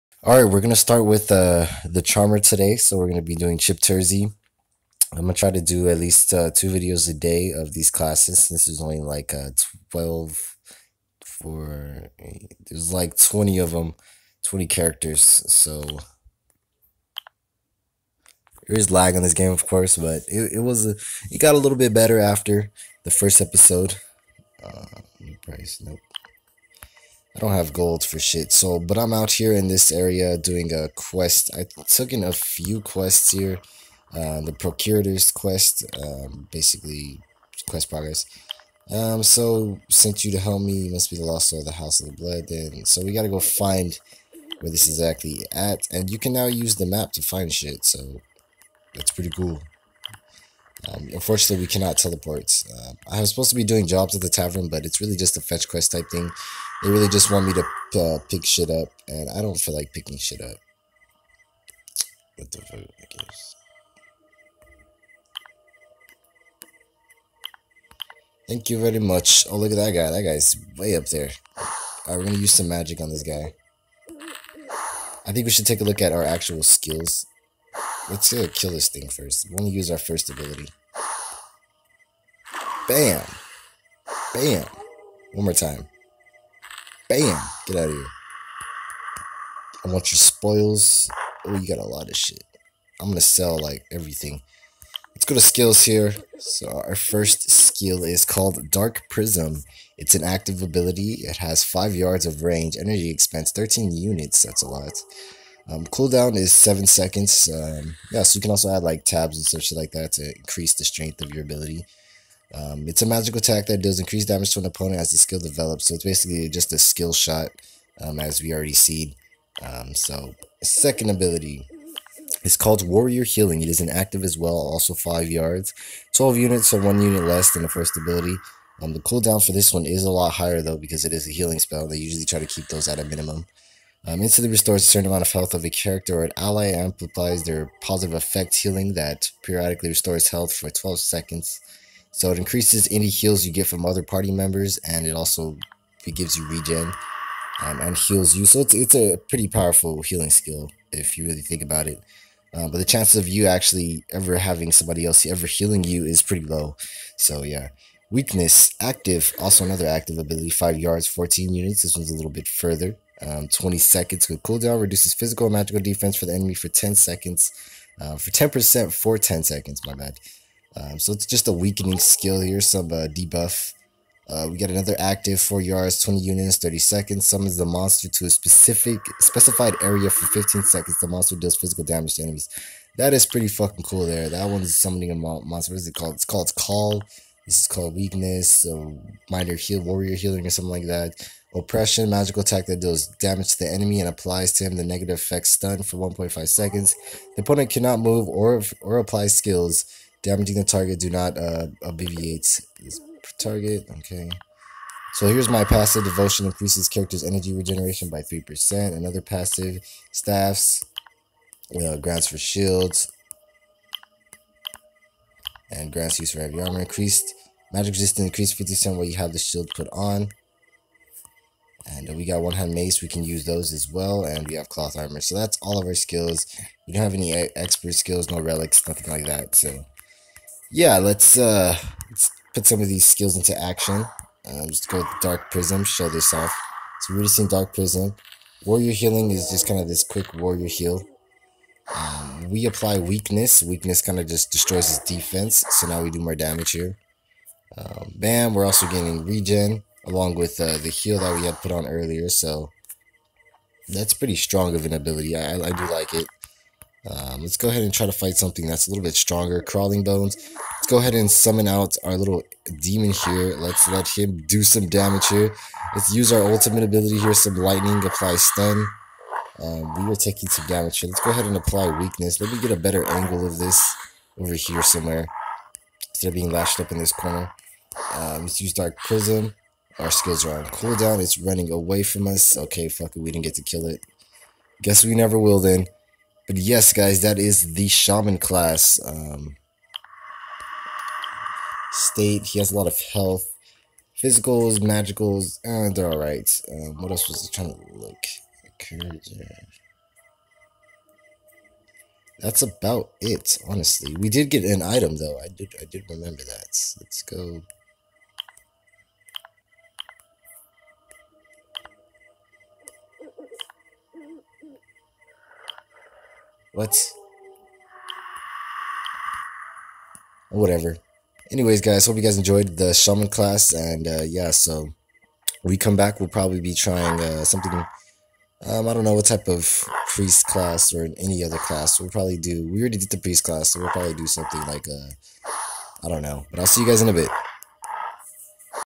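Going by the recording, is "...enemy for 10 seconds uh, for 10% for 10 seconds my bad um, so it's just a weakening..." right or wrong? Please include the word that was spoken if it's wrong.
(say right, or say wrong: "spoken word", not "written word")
right.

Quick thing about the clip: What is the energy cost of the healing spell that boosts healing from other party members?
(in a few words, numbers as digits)
12.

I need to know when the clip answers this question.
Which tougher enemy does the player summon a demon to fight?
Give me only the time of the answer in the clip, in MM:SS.
04:19.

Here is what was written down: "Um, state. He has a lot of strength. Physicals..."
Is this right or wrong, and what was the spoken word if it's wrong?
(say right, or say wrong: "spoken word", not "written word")
wrong: "health", not "strength".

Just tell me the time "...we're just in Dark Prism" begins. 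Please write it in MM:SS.
03:57.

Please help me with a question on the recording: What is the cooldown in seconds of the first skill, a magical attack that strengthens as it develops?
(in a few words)
7.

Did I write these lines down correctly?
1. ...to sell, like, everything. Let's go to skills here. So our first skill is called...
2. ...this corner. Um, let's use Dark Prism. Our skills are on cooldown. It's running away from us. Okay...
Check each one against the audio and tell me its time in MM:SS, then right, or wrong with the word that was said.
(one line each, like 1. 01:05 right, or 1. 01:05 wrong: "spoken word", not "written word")
1. 01:33 right
2. 04:36 right.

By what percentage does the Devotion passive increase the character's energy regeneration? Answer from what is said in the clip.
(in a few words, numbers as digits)
3%.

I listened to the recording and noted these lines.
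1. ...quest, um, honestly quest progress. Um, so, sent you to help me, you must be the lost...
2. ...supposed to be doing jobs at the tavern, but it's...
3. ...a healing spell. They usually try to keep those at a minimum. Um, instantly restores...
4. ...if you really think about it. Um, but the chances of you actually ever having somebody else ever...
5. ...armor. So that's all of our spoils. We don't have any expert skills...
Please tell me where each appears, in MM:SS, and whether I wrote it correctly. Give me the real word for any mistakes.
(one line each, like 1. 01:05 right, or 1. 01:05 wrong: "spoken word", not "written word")
1. 00:35 wrong: "basically", not "honestly"
2. 00:53 right
3. 02:11 right
4. 02:30 right
5. 03:44 wrong: "skills", not "spoils".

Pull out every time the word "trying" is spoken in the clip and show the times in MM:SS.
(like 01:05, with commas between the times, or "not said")
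04:57, 05:26.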